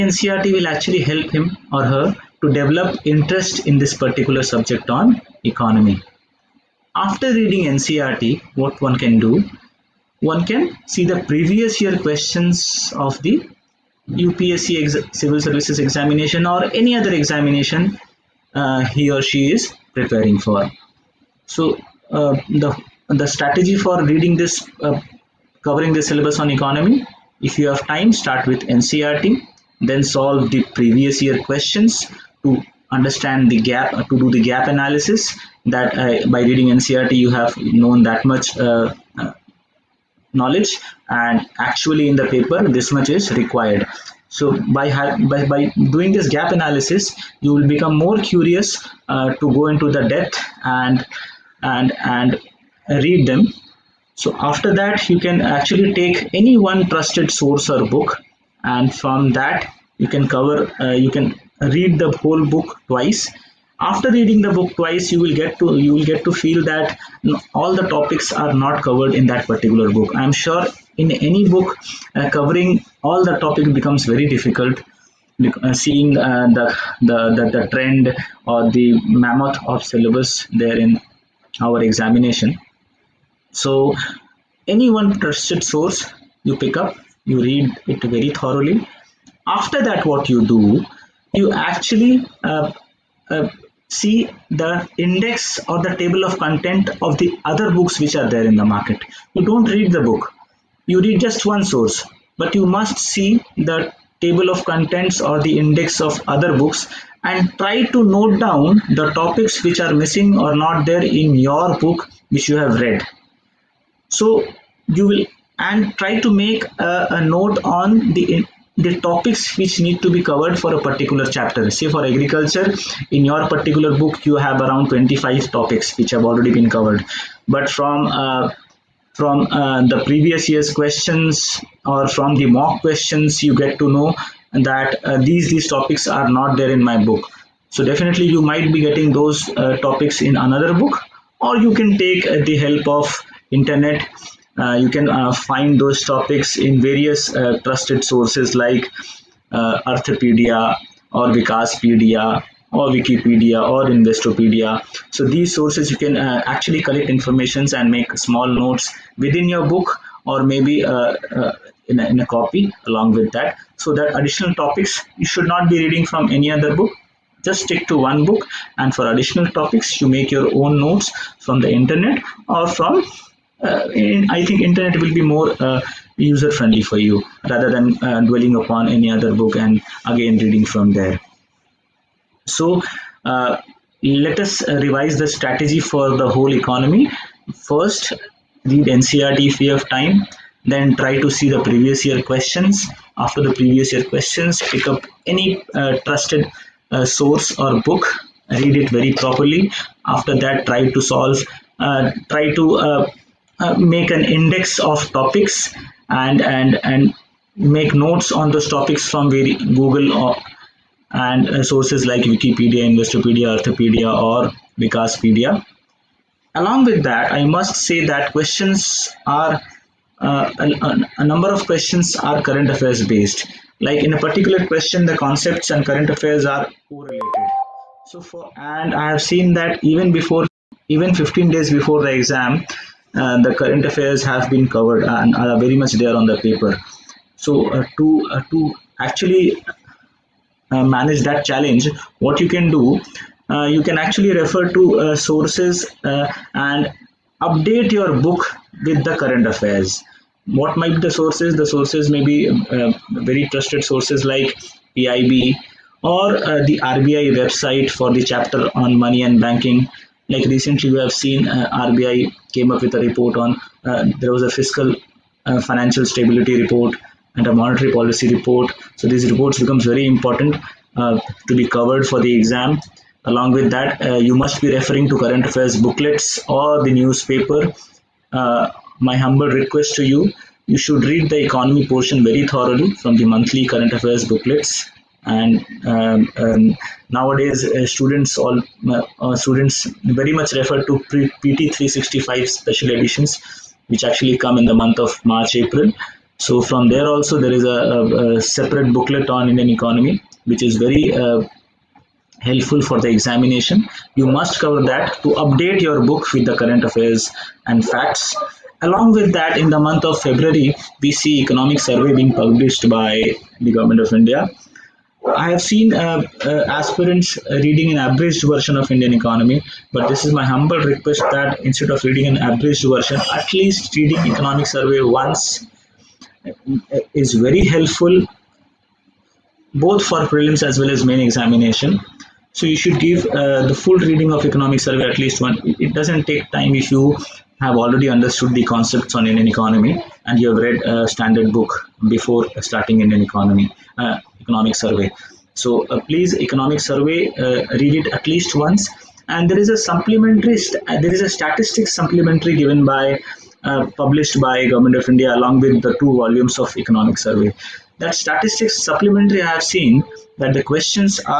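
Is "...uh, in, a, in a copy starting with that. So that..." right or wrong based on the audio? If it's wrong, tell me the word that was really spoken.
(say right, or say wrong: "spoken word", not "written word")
wrong: "along", not "starting".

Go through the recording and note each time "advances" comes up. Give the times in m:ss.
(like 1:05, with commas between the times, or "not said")
not said.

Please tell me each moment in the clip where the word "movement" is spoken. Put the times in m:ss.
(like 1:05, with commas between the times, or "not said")
not said.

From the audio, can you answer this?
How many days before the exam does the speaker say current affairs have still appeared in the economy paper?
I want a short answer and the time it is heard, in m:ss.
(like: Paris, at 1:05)
15 days, at 3:51.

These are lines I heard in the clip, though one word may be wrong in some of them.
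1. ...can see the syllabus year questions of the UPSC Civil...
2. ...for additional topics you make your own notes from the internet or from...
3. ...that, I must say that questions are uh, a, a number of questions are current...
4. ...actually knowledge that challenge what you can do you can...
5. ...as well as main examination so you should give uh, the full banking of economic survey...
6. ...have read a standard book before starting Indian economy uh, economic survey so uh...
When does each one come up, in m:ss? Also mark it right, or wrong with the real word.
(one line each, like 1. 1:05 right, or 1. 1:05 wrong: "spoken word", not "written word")
1. 0:10 wrong: "previous", not "syllabus"
2. 2:48 right
3. 3:37 right
4. 3:58 wrong: "manage", not "knowledge"
5. 5:30 wrong: "reading", not "banking"
6. 5:40 right.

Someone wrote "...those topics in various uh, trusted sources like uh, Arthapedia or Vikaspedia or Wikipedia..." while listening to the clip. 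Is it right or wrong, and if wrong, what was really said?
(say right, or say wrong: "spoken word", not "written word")
right.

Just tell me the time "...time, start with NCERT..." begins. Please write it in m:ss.
0:27.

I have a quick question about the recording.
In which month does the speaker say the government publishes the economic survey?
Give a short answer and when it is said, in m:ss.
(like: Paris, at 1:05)
February, at 5:10.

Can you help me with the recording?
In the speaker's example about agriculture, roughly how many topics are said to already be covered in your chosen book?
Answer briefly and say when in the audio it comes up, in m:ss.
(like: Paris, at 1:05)
25, at 2:04.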